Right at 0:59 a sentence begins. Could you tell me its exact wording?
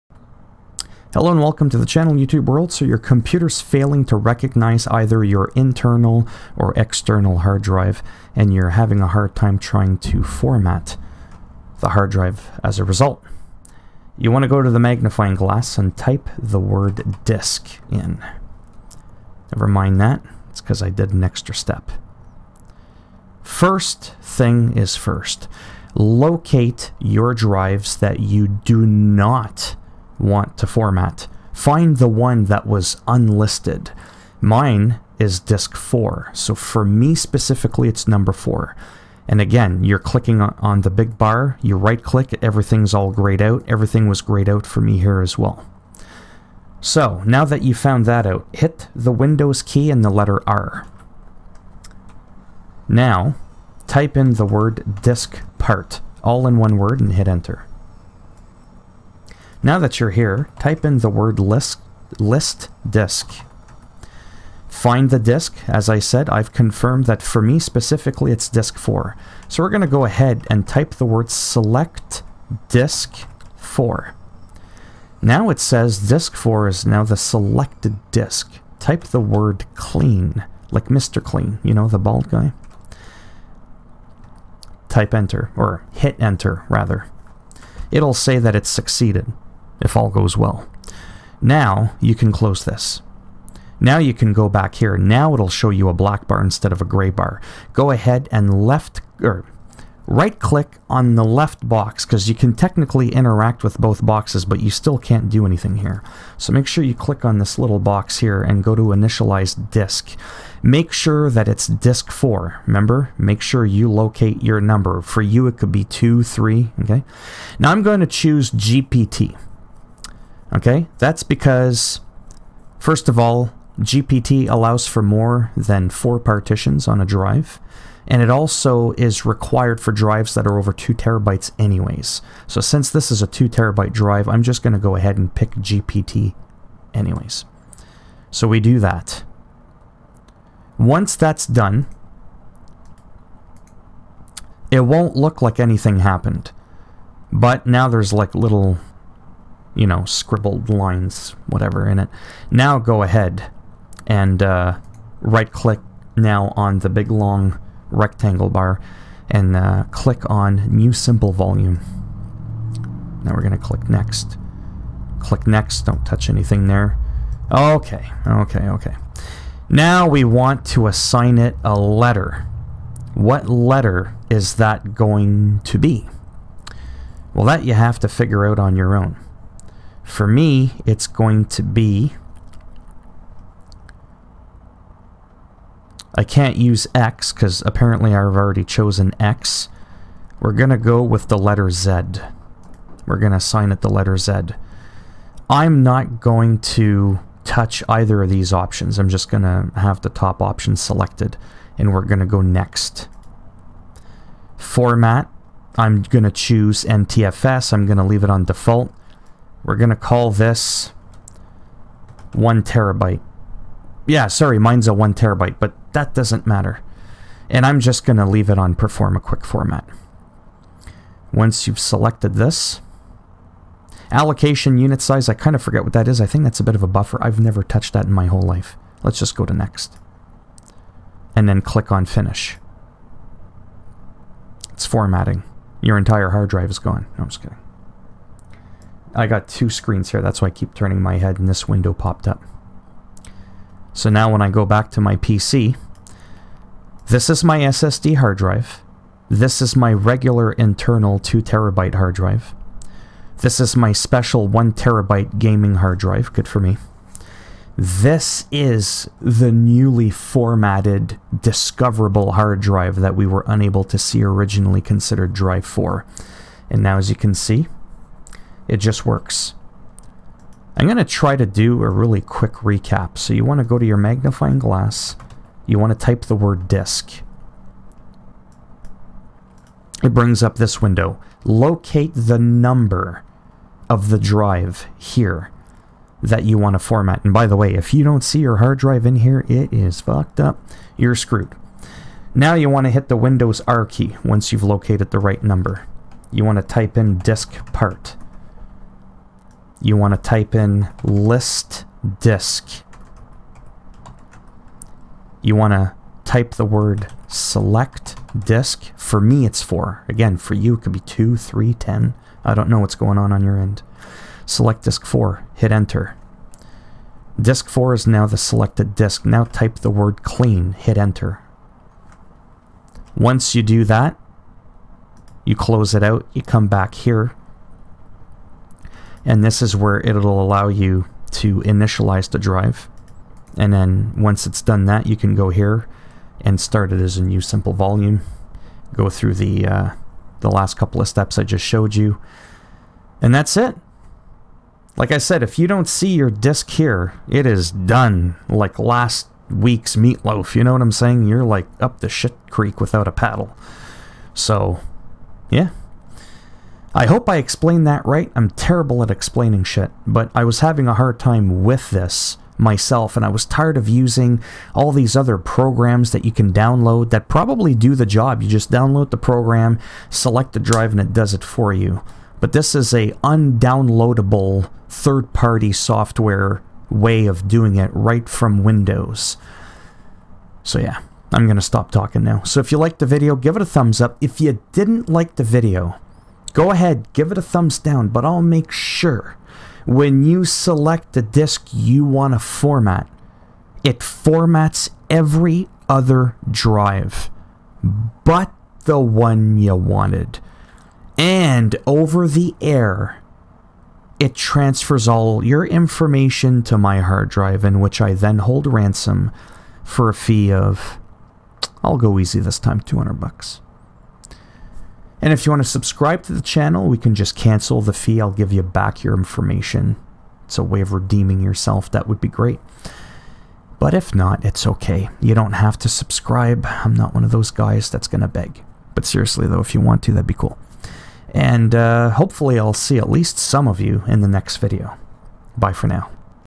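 Now that you're here, type in the word list, list disk.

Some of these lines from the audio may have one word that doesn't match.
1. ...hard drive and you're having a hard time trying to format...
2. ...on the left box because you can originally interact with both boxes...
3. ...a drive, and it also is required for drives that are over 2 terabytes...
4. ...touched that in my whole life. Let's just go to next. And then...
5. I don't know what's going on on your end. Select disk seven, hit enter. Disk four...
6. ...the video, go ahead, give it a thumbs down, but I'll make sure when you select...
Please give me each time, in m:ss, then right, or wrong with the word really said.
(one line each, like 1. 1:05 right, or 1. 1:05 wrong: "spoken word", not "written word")
1. 0:07 right
2. 1:40 wrong: "technically", not "originally"
3. 2:06 right
4. 3:47 right
5. 5:12 wrong: "four", not "seven"
6. 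6:25 right.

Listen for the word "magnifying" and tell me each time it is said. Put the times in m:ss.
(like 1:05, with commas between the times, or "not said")
0:14, 4:33.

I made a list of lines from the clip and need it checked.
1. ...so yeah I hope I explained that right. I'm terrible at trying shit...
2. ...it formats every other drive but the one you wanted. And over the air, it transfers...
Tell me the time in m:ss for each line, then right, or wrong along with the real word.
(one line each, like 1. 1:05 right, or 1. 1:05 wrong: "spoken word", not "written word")
1. 5:54 wrong: "explaining", not "trying"
2. 6:33 right.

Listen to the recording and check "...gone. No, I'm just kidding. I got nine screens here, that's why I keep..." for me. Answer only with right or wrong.
wrong.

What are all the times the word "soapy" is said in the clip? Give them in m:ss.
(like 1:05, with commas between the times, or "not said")
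not said.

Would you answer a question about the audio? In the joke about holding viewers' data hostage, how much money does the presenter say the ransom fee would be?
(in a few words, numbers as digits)
200 bucks.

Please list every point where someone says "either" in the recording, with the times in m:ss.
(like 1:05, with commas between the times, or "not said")
0:04, 3:17.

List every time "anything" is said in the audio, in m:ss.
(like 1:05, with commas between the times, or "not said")
1:45, 2:25, 2:46.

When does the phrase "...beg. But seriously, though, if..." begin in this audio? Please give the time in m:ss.
7:08.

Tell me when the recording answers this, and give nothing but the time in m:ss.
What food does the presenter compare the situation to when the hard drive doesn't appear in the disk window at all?
5:48.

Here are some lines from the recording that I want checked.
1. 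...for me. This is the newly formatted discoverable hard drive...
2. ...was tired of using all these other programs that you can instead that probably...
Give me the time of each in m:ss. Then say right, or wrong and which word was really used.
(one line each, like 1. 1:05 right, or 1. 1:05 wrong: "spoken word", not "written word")
1. 4:16 right
2. 6:03 wrong: "download", not "instead".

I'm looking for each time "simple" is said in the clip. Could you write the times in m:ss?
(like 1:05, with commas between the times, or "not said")
2:40, 5:37.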